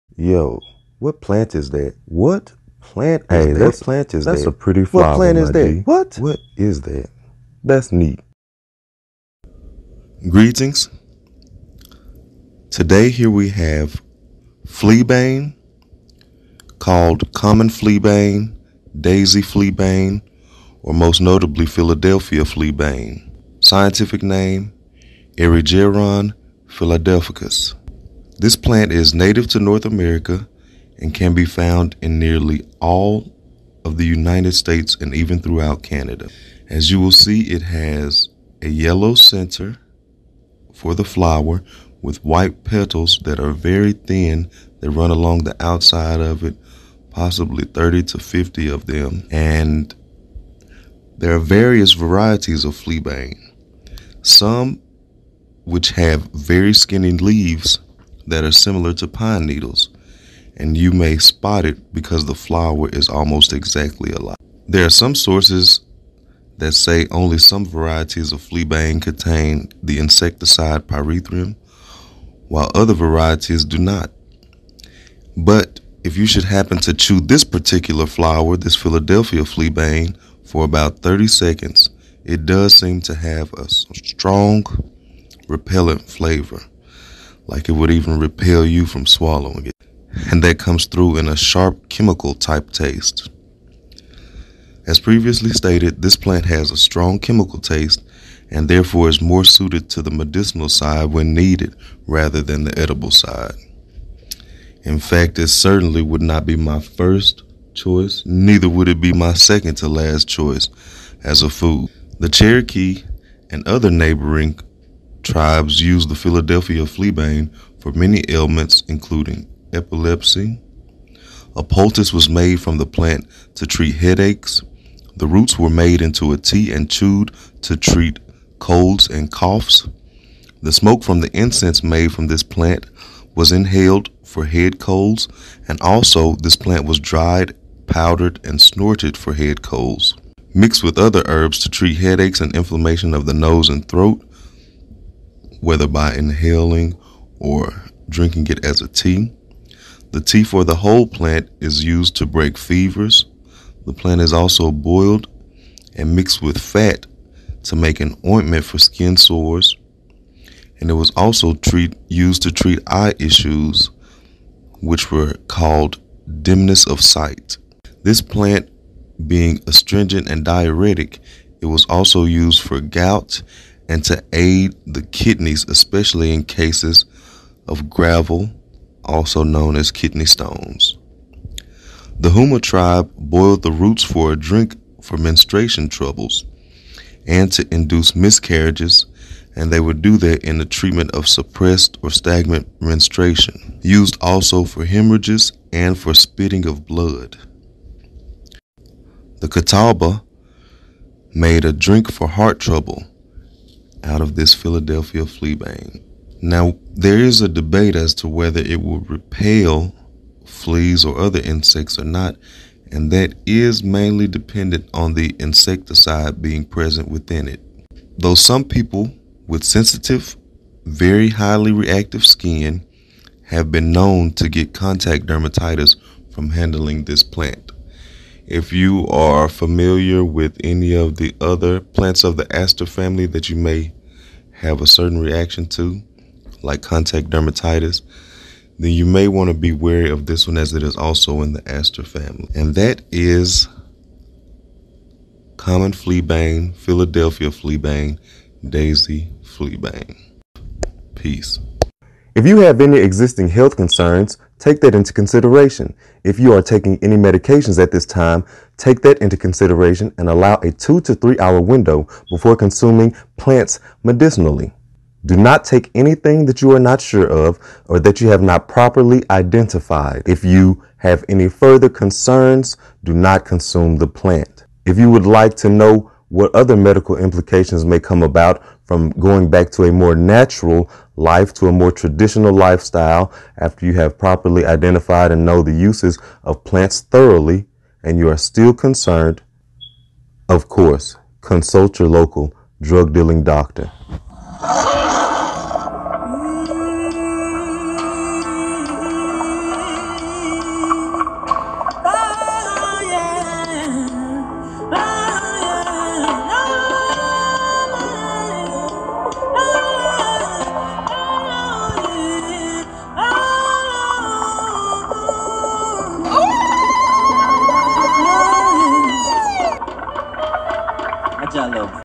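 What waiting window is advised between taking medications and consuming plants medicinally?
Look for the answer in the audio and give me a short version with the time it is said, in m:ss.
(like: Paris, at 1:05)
2 to 3 hours, at 4:20.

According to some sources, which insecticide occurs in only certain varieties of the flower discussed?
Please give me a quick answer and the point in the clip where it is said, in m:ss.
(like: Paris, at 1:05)
pyrethrum, at 1:10.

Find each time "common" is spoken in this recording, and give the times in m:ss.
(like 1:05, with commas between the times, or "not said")
0:17, 4:05.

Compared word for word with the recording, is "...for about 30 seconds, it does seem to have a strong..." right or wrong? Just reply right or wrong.
right.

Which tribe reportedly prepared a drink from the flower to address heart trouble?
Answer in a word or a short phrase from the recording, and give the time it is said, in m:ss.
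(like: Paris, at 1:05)
Catawba, at 3:19.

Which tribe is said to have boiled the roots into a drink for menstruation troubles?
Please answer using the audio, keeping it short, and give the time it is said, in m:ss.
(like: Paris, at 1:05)
Houma, at 3:02.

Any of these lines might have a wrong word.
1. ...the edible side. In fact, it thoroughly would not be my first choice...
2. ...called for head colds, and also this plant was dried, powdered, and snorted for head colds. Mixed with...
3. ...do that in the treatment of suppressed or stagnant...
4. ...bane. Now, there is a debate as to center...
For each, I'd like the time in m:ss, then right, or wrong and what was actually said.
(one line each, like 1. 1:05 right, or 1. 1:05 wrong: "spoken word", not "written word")
1. 1:42 wrong: "certainly", not "thoroughly"
2. 2:13 wrong: "inhaled", not "called"
3. 3:10 right
4. 3:25 wrong: "whether", not "center".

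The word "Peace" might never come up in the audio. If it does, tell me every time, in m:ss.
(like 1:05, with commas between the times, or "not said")
4:11.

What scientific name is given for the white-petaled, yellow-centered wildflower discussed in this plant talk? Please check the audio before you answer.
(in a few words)
Erigeron philadelphicus.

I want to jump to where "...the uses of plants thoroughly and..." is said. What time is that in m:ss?
4:45.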